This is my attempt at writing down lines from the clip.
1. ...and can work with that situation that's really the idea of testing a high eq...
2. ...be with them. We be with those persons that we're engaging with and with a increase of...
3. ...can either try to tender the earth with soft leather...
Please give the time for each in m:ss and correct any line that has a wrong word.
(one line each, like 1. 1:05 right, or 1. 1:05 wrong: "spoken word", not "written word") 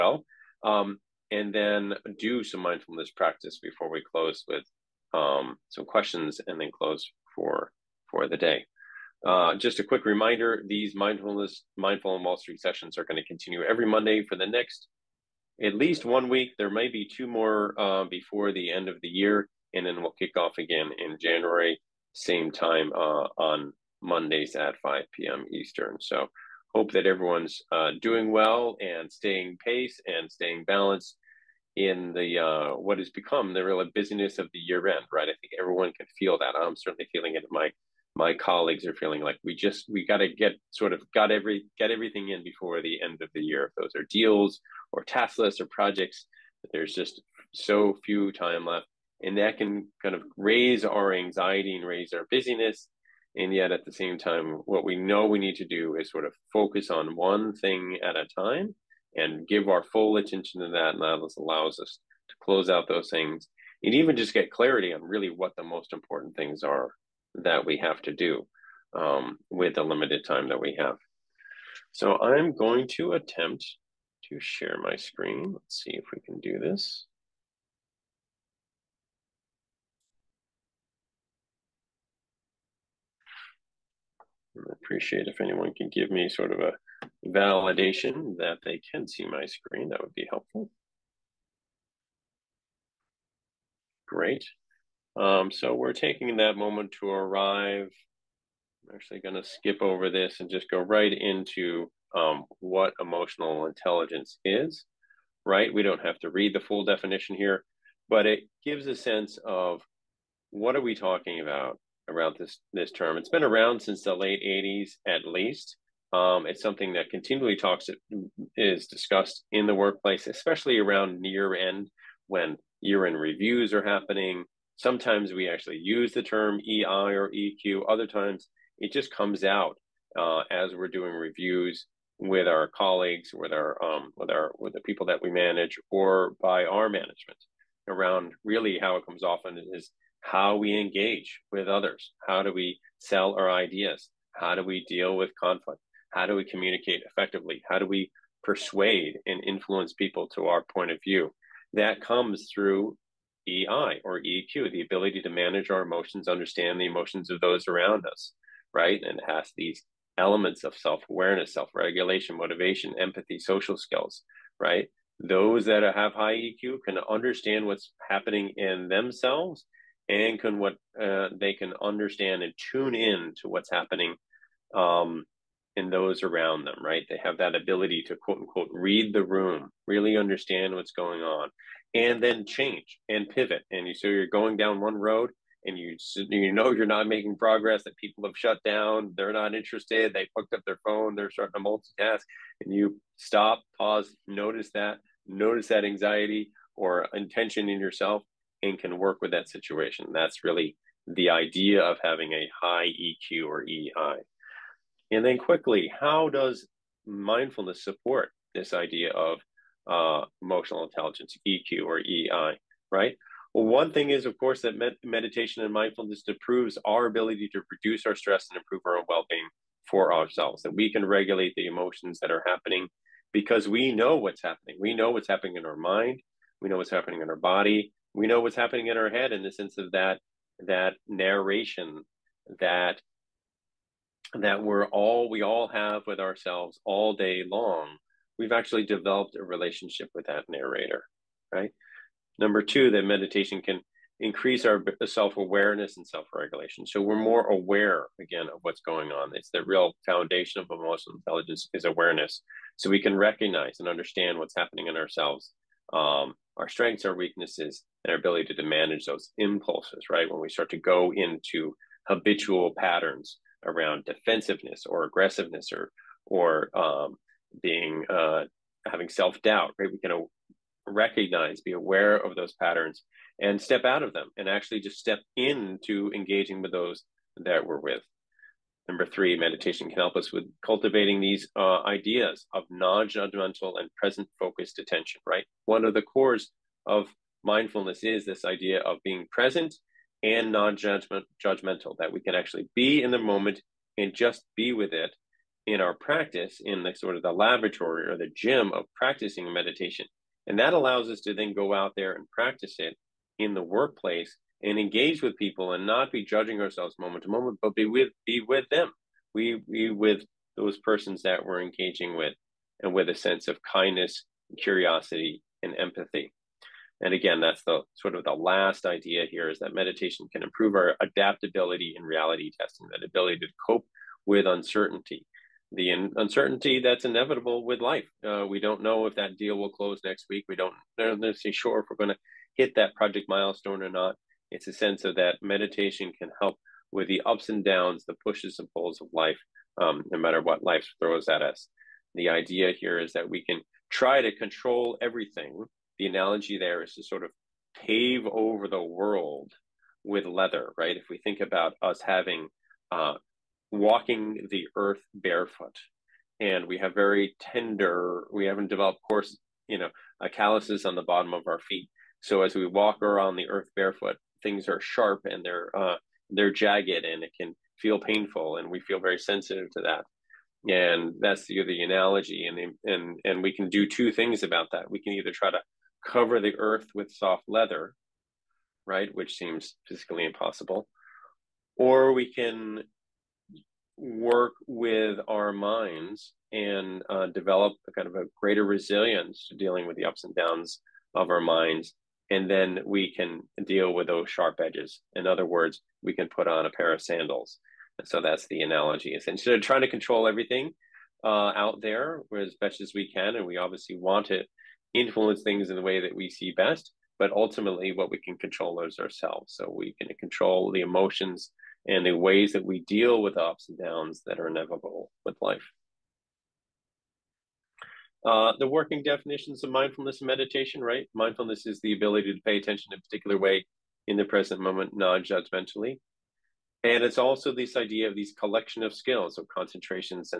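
1. 3:18 wrong: "having", not "testing"
2. 5:08 wrong: "sense", not "increase"
3. 6:14 wrong: "cover", not "tender".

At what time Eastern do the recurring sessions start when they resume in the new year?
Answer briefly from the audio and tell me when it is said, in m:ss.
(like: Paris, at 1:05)
5 p.m., at 0:24.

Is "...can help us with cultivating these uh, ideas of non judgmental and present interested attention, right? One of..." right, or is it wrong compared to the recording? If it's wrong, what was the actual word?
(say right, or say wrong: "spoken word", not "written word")
wrong: "focused", not "interested".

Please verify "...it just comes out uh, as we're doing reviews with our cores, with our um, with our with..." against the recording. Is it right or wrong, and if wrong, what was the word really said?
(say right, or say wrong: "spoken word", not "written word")
wrong: "colleagues", not "cores".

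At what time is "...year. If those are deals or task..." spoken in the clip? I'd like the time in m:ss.
0:43.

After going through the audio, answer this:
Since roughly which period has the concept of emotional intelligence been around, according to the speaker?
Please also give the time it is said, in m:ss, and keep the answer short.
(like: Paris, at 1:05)
the late 80s, at 1:54.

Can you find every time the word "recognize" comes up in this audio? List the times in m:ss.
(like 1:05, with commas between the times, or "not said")
4:13, 4:30.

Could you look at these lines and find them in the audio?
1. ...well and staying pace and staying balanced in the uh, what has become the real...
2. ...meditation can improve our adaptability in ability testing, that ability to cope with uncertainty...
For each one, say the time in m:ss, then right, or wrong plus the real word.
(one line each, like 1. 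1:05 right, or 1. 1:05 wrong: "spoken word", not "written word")
1. 0:28 right
2. 5:19 wrong: "reality", not "ability".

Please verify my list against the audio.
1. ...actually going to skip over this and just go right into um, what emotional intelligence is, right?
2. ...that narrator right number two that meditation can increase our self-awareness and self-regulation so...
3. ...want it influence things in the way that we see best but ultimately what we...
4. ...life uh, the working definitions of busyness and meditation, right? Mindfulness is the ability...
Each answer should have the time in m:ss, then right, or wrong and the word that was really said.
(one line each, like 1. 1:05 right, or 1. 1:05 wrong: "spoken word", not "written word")
1. 1:38 right
2. 4:00 right
3. 6:43 right
4. 6:55 wrong: "mindfulness", not "busyness".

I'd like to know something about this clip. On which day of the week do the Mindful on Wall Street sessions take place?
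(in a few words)
Monday.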